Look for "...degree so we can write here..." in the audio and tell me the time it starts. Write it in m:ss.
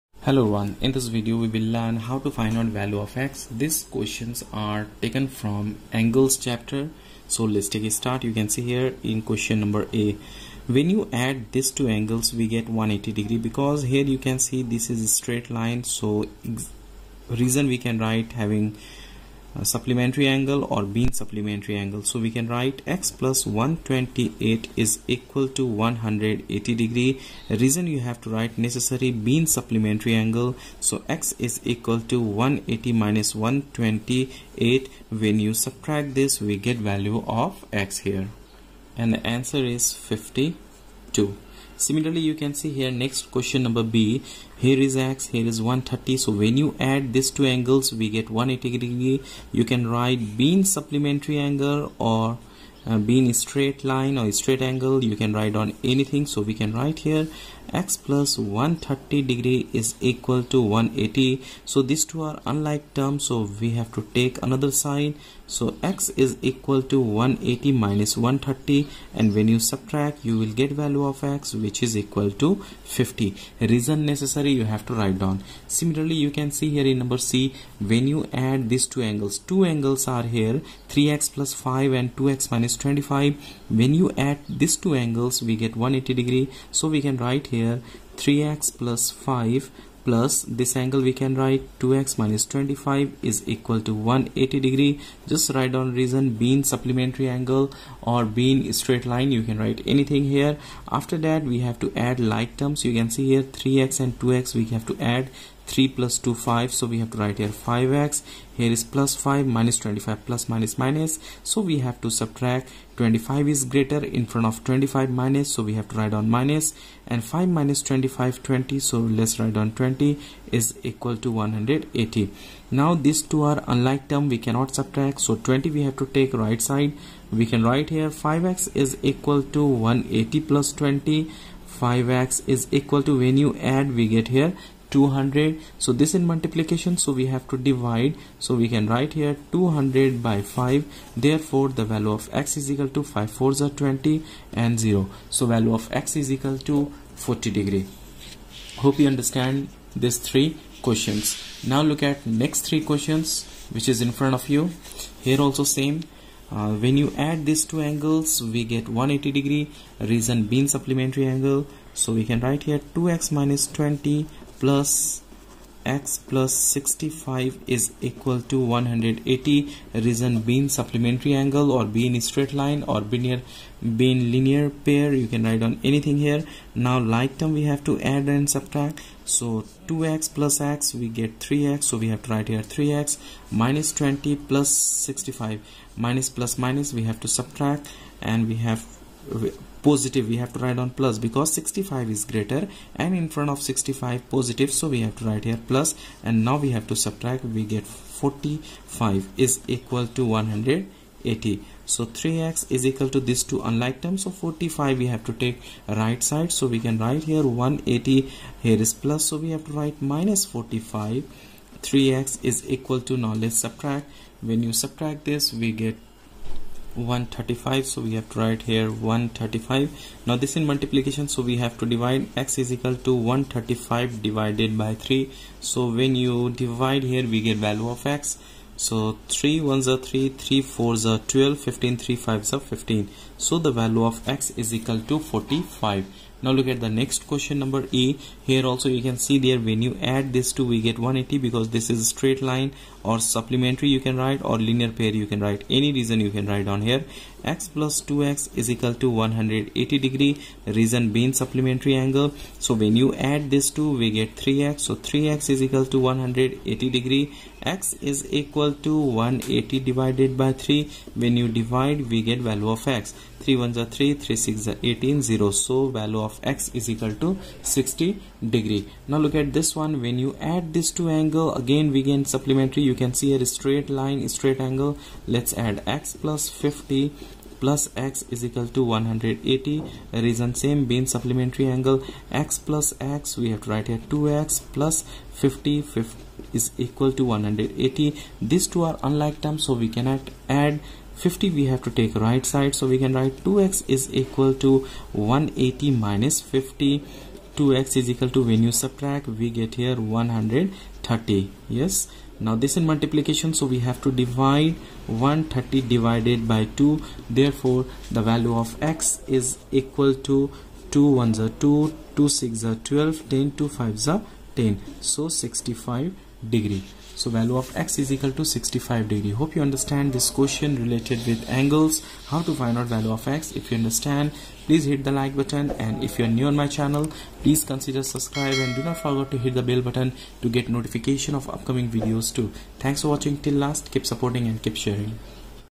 1:26.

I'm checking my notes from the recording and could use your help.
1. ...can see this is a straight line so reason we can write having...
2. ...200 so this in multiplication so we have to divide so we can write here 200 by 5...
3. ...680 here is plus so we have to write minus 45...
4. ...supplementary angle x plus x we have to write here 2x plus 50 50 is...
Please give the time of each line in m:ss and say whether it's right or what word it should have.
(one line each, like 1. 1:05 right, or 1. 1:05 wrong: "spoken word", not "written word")
1. 0:14 right
2. 2:14 right
3. 3:27 wrong: "180", not "680"
4. 4:41 right.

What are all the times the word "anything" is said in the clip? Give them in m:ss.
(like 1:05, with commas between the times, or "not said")
0:55, 1:39, 2:55.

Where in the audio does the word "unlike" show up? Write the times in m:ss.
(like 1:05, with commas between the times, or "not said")
1:02, 2:03, 3:23, 4:49.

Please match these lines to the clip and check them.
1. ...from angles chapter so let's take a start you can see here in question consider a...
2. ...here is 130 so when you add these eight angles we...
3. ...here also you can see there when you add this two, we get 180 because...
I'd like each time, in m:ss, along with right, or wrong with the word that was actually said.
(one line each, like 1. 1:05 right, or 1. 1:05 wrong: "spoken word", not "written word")
1. 0:05 wrong: "number", not "consider"
2. 0:45 wrong: "two", not "eight"
3. 3:58 right.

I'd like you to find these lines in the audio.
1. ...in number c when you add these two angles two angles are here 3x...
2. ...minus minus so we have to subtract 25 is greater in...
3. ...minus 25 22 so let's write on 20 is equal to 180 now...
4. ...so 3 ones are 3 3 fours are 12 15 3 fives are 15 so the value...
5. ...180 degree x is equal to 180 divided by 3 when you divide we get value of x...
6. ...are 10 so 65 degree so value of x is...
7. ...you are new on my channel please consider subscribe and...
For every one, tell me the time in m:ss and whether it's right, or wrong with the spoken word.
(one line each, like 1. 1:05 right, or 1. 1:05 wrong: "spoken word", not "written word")
1. 1:16 right
2. 1:50 right
3. 1:57 wrong: "20", not "22"
4. 3:48 right
5. 4:15 right
6. 5:14 right
7. 5:26 right.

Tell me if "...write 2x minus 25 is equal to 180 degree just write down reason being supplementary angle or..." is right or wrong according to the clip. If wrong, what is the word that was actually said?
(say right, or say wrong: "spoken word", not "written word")
right.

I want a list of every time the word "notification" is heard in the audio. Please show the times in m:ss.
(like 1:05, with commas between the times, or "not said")
5:30.